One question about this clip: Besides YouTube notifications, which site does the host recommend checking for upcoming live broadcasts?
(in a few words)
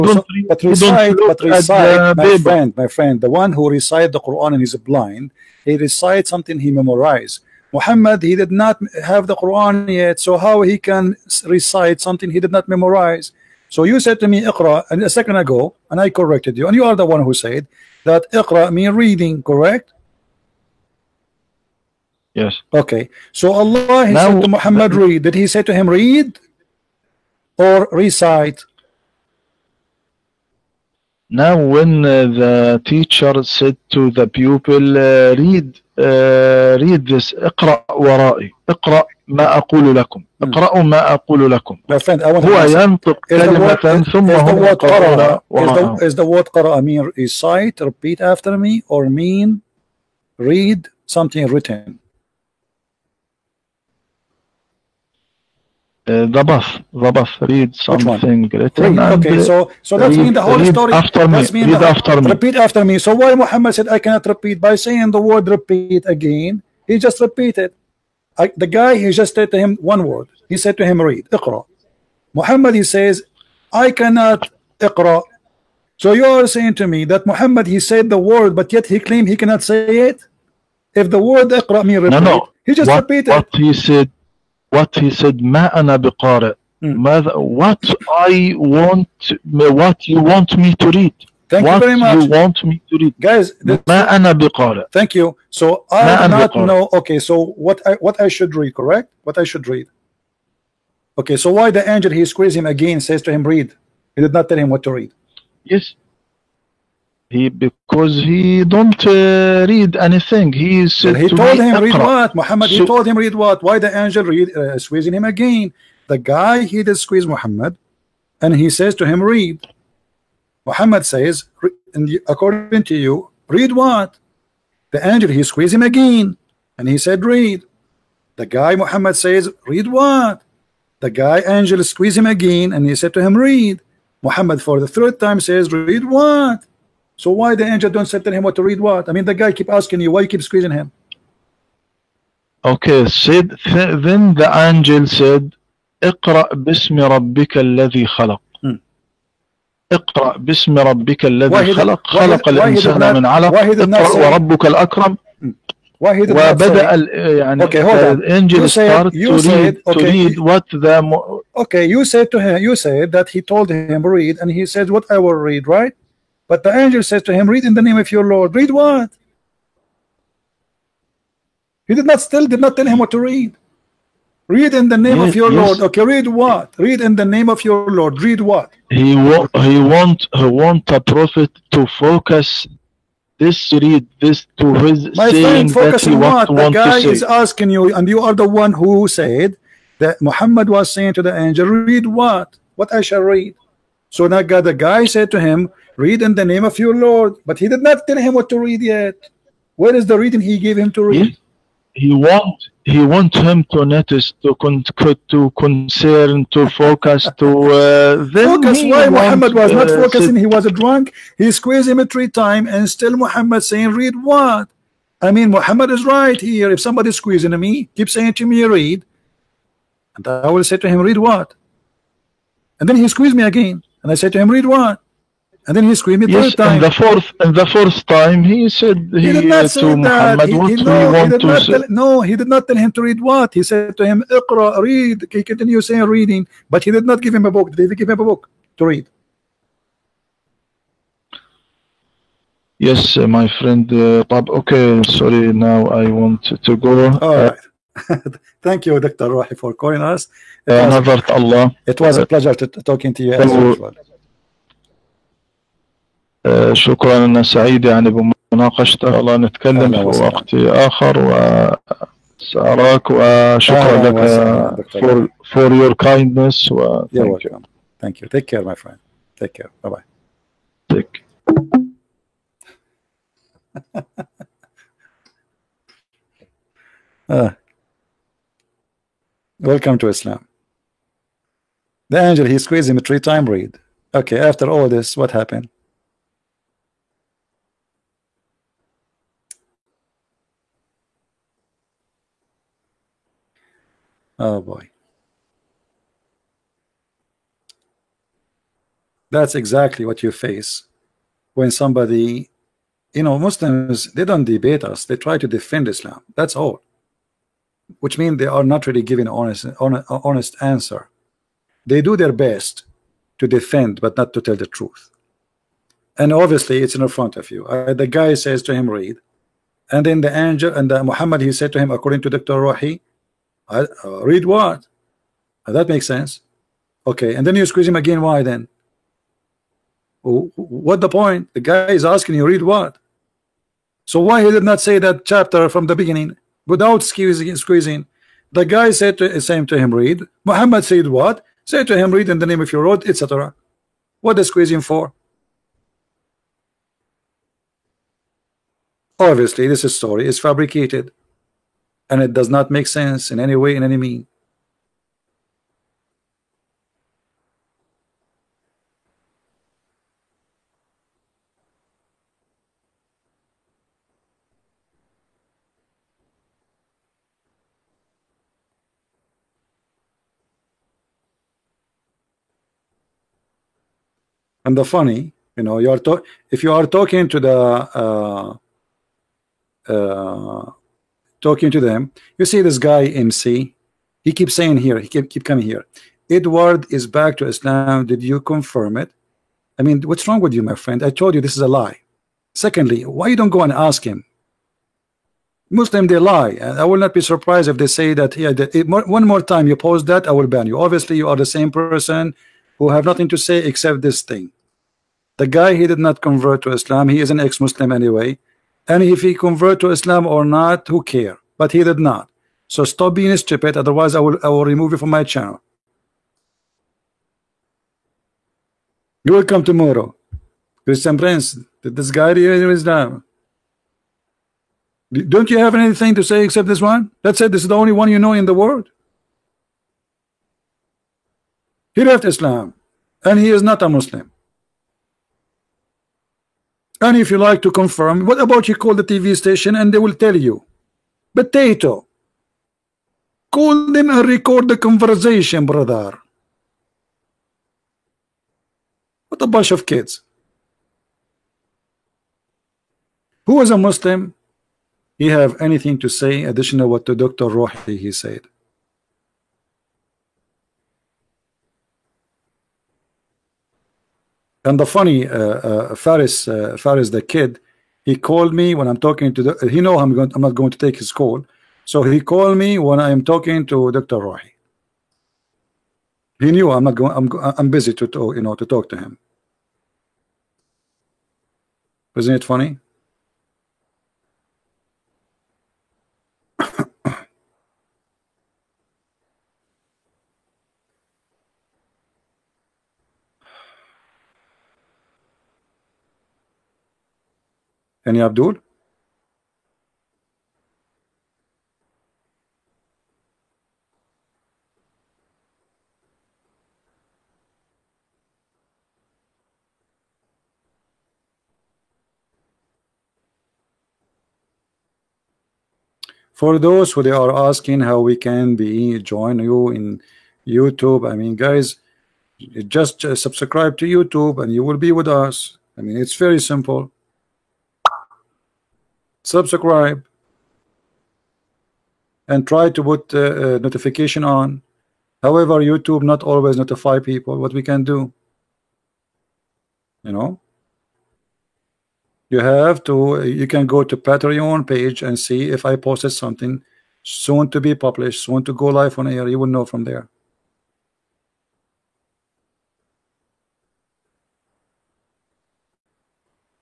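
Patreon.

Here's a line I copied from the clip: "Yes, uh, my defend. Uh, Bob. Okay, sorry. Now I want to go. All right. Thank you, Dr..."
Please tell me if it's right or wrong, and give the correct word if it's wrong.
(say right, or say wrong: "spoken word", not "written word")
wrong: "friend", not "defend".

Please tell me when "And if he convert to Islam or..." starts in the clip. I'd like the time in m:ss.
6:48.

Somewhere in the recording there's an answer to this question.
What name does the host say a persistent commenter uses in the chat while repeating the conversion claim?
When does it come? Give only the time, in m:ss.
6:23.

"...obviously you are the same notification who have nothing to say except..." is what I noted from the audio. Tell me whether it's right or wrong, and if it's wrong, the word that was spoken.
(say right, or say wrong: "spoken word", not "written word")
wrong: "person", not "notification".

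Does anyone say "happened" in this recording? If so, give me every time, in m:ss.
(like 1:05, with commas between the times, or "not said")
4:45.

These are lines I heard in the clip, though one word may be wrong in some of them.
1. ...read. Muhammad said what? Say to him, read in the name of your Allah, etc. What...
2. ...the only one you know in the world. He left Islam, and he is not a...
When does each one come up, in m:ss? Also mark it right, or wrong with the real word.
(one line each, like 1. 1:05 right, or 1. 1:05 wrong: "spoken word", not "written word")
1. 5:39 wrong: "Lord", not "Allah"
2. 7:07 right.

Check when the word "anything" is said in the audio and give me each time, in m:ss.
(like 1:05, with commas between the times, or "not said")
1:49, 7:05, 7:35.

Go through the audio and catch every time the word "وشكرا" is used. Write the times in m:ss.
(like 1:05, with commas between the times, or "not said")
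4:23.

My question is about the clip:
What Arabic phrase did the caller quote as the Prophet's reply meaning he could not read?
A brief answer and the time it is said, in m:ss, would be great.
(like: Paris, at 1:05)
ما أنا بقارئ, at 1:25.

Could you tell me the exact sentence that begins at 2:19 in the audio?
I mean, the guy keep asking you, why you keep squeezing him?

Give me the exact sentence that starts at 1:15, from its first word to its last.
So you are saying to me that Muhammad he said the word, but yet he claimed he cannot say it.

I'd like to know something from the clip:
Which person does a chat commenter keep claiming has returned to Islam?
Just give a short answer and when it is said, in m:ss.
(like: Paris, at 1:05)
Edward, at 6:26.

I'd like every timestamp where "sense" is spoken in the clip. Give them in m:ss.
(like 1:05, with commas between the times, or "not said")
5:26, 5:52.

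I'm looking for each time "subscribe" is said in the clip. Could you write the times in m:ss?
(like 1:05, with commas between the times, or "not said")
8:43, 8:49.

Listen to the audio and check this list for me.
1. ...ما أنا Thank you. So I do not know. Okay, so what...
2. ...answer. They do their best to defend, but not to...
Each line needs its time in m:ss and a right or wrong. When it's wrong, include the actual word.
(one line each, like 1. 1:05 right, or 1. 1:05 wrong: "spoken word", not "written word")
1. 1:33 right
2. 5:10 right.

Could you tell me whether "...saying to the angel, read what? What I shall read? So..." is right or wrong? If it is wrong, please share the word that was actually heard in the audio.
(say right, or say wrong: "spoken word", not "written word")
right.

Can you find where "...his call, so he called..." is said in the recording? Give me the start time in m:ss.
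7:51.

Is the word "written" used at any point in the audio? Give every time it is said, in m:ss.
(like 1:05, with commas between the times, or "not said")
0:51, 0:58.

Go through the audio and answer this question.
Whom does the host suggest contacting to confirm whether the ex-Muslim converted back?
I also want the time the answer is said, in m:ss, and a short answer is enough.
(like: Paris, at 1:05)
the TV station, at 7:19.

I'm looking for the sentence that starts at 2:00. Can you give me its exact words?
Muhammad says, according to you, read what?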